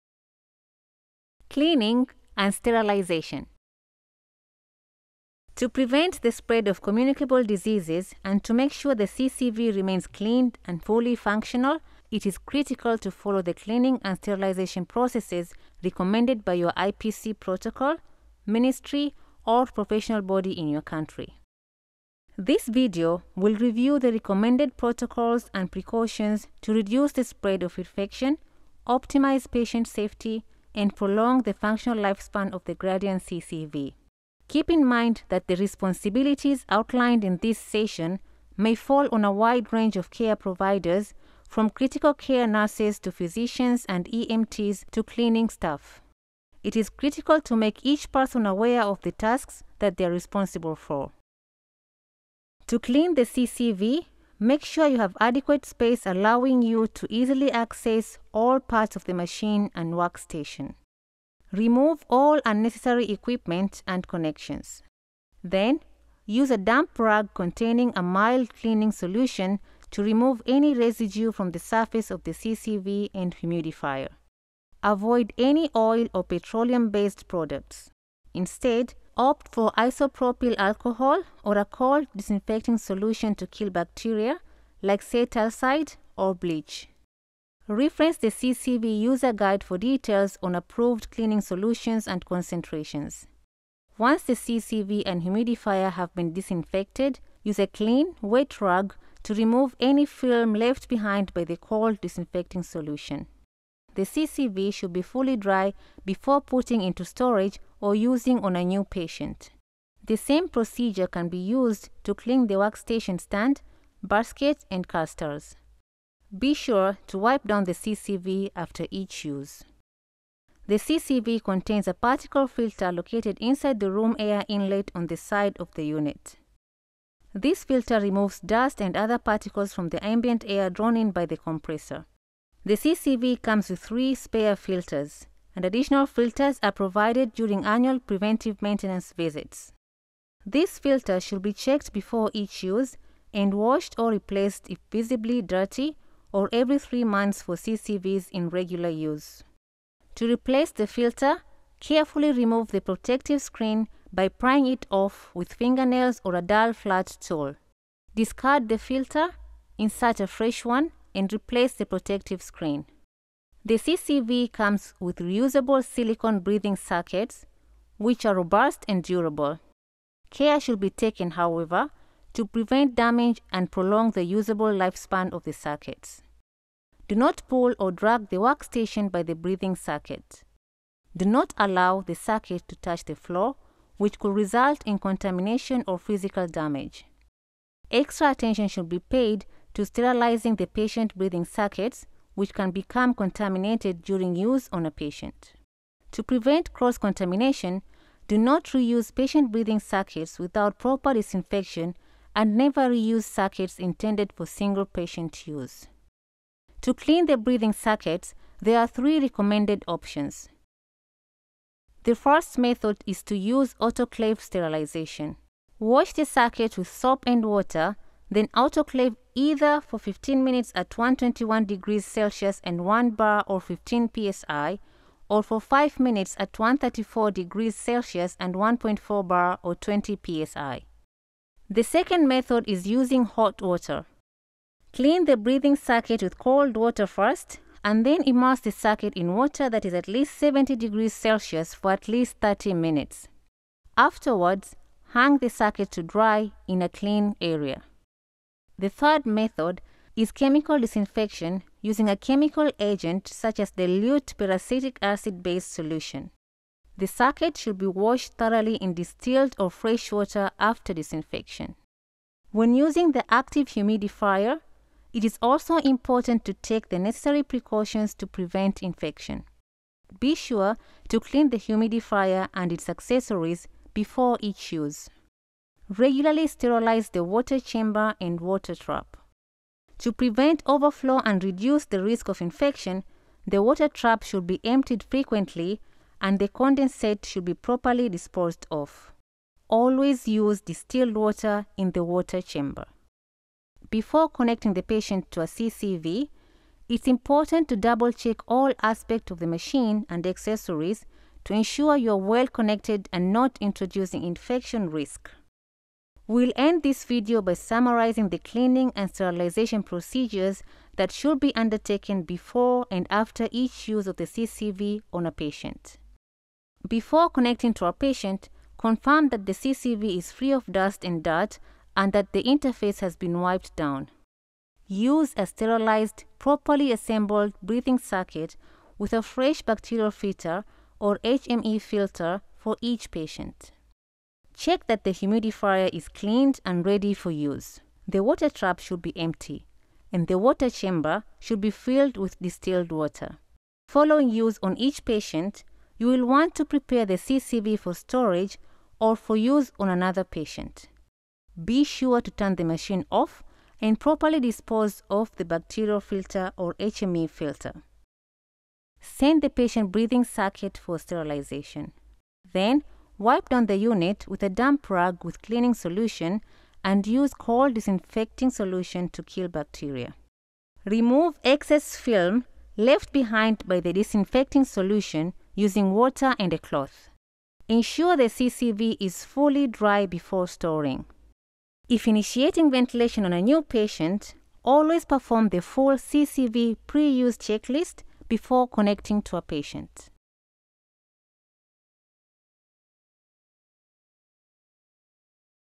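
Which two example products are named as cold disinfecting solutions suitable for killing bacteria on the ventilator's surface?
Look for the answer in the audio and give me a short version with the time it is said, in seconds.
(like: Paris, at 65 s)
Cetylcide or bleach, at 85 s.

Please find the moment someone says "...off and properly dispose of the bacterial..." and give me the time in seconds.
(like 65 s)
353 s.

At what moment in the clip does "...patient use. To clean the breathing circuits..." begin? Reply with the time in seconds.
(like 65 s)
204 s.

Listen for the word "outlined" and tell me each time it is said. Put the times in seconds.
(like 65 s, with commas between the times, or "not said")
36 s.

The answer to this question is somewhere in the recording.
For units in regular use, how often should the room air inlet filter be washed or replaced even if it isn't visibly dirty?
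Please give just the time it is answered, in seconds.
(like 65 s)
146 s.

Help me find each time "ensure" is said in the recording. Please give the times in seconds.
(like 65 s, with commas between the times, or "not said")
301 s, 377 s.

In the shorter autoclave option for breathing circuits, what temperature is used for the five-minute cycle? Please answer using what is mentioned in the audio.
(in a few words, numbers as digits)
134 degrees Celsius.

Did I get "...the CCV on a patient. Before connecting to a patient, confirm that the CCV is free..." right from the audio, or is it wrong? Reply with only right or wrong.
right.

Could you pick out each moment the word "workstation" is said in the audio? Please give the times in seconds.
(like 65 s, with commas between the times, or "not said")
59 s, 112 s, 178 s.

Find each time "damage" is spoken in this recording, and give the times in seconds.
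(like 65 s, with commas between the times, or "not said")
172 s, 186 s.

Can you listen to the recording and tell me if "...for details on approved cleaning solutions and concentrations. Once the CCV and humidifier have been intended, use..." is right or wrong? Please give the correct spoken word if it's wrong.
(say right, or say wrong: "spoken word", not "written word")
wrong: "disinfected", not "intended".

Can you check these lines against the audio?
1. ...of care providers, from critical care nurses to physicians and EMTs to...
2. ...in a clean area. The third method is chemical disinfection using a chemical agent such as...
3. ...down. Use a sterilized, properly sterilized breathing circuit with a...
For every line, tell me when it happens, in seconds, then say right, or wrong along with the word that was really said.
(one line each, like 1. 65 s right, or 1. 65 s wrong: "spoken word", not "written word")
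1. 39 s right
2. 246 s right
3. 323 s wrong: "assembled", not "sterilized".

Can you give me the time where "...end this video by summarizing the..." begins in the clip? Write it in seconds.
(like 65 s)
306 s.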